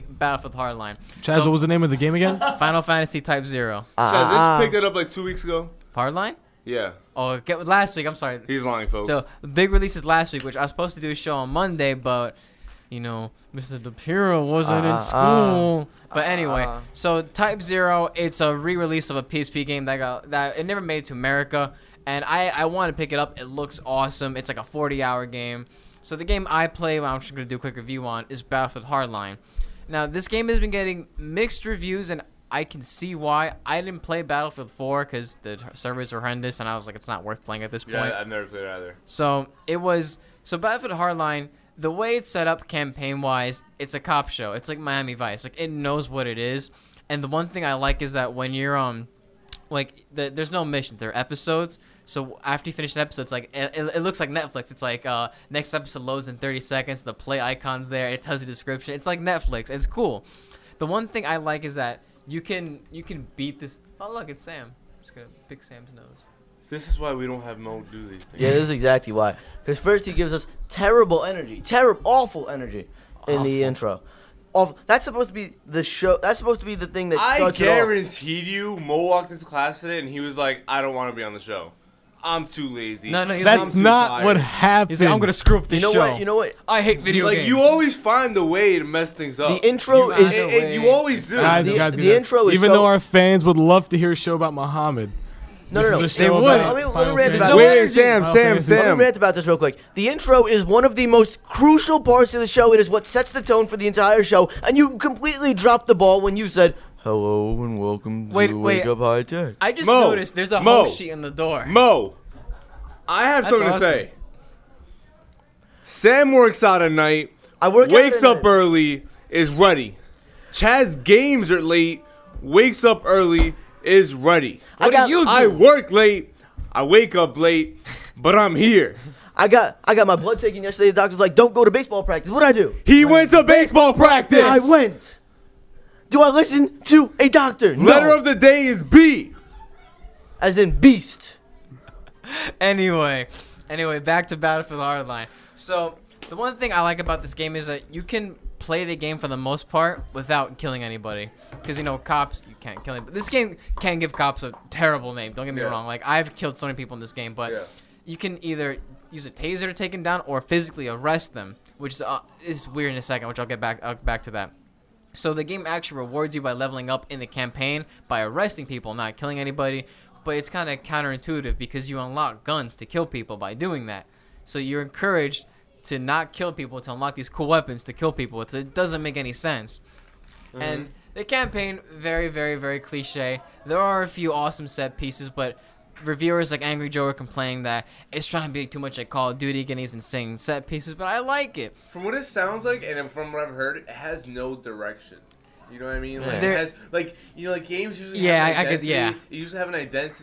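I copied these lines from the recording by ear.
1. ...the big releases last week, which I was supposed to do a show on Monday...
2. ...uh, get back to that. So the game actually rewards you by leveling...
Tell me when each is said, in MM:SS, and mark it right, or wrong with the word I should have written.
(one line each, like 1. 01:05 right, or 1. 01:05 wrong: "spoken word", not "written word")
1. 00:09 right
2. 02:43 right.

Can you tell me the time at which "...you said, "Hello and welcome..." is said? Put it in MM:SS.
01:46.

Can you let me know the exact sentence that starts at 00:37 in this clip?
Yeah, I've never played it either.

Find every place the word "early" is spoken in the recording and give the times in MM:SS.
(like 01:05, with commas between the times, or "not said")
01:58, 02:03.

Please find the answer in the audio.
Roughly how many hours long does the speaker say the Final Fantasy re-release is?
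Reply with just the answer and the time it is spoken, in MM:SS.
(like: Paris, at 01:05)
40, at 00:24.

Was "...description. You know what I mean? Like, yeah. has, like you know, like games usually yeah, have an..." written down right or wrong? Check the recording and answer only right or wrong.
wrong.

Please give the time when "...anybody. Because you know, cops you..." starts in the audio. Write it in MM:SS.
02:30.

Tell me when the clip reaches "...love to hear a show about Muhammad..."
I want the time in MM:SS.
01:33.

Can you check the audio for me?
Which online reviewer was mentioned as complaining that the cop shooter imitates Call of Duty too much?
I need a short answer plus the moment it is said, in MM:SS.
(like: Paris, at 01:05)
Angry Joe, at 03:06.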